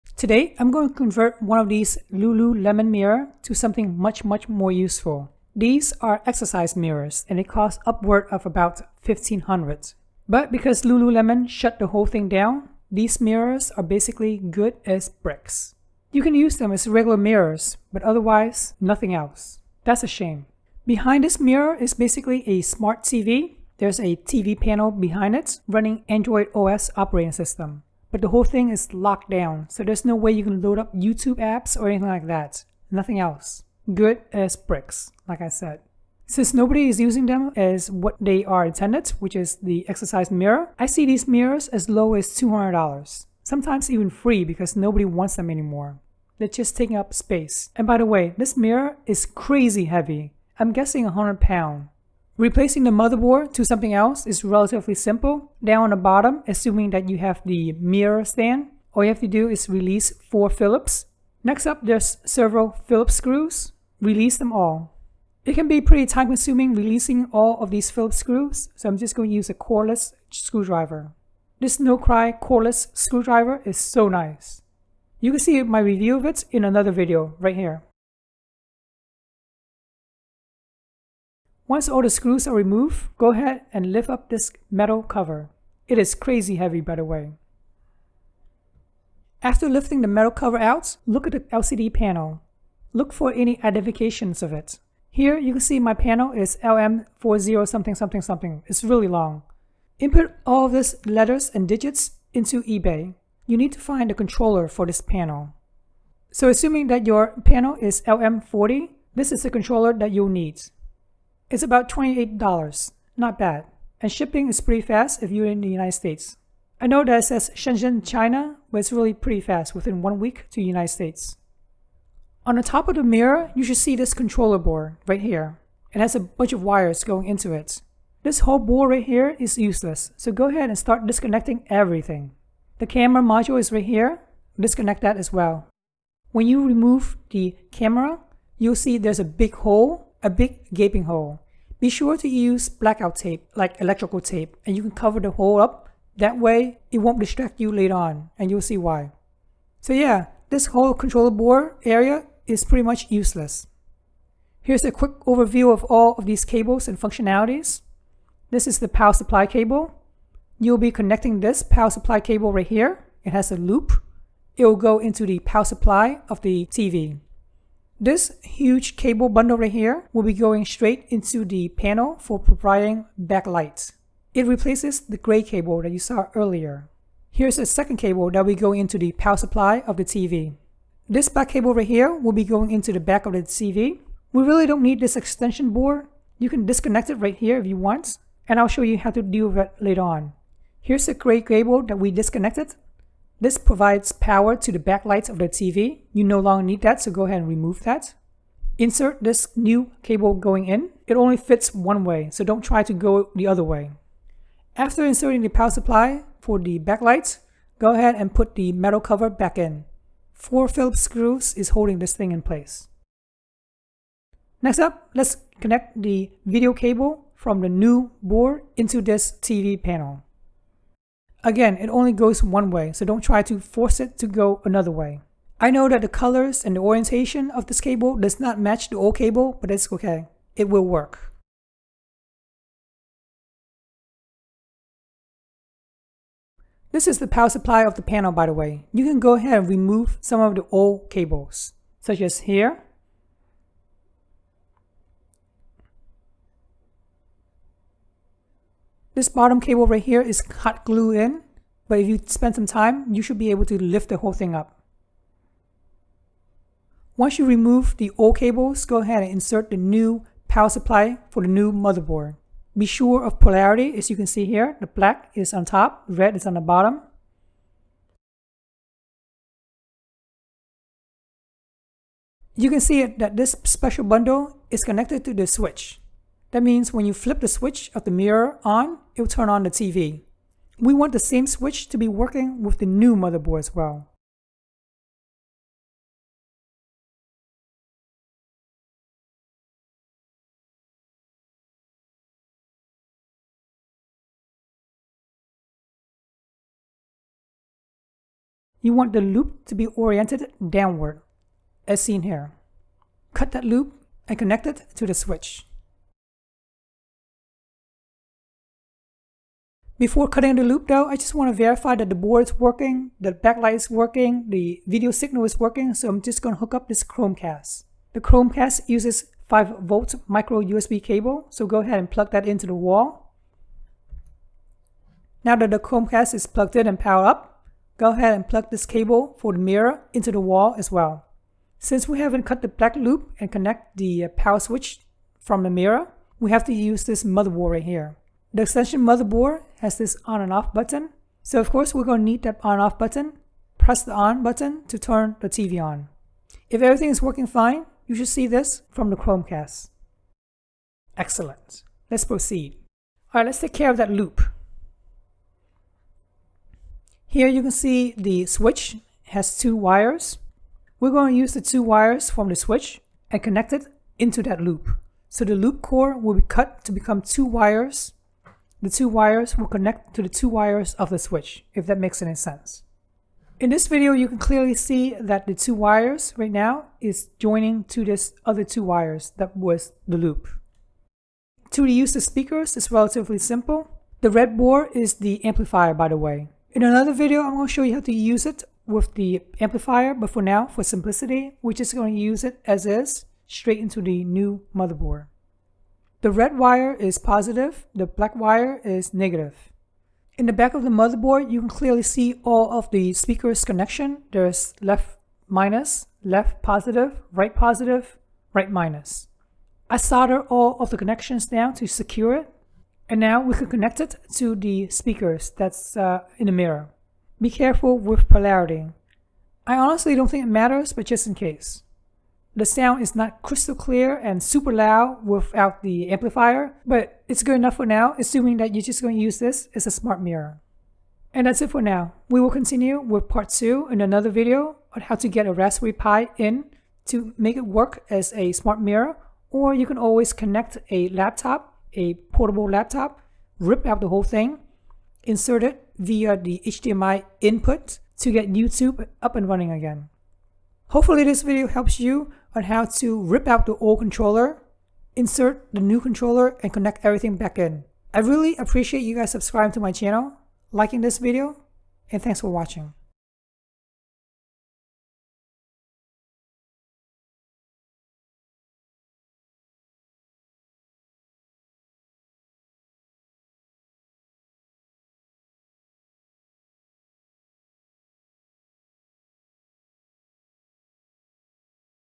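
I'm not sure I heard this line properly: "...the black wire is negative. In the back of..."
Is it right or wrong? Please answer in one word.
right.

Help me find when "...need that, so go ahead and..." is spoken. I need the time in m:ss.
3:16.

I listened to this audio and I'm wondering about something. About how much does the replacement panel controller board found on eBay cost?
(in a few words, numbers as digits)
$28.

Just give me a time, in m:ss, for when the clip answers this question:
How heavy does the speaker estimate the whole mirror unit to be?
0:51.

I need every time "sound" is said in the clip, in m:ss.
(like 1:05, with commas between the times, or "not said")
7:02.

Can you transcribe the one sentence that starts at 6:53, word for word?
And now we can connect it to the speakers that's uh, in the mirror.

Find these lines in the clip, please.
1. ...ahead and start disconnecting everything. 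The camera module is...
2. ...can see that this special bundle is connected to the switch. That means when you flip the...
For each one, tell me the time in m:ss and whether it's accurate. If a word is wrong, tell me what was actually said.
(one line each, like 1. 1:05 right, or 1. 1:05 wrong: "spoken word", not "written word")
1. 2:10 right
2. 4:32 right.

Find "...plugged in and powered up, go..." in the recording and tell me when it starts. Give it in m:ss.
5:26.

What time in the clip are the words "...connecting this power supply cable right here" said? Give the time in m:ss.
2:40.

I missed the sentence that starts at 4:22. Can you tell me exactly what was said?
Be sure of polarity as you can see here, the black is on top, red is on the bottom.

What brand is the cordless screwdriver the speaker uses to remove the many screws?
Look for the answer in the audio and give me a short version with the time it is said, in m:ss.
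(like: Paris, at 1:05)
Nocry, at 1:11.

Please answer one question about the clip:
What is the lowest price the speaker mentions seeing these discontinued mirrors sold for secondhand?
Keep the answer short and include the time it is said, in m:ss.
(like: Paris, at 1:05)
$200, at 0:42.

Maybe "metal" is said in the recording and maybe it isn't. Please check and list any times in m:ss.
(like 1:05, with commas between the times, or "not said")
1:24, 1:30, 3:28.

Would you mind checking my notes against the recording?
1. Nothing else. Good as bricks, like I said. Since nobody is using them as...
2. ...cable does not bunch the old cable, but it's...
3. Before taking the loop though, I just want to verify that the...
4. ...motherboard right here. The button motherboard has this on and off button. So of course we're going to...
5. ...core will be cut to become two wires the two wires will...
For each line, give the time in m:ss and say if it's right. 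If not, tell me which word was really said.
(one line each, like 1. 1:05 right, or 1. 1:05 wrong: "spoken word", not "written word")
1. 0:32 right
2. 3:47 wrong: "match", not "bunch"
3. 5:10 wrong: "cutting", not "taking"
4. 5:37 wrong: "extension", not "button"
5. 6:05 right.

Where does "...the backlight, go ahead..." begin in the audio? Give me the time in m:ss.
3:26.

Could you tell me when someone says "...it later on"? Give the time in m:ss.
3:09.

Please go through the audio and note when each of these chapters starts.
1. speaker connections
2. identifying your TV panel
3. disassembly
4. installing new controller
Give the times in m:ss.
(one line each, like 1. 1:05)
1. 6:21
2. 1:29
3. 0:52
4. 2:01.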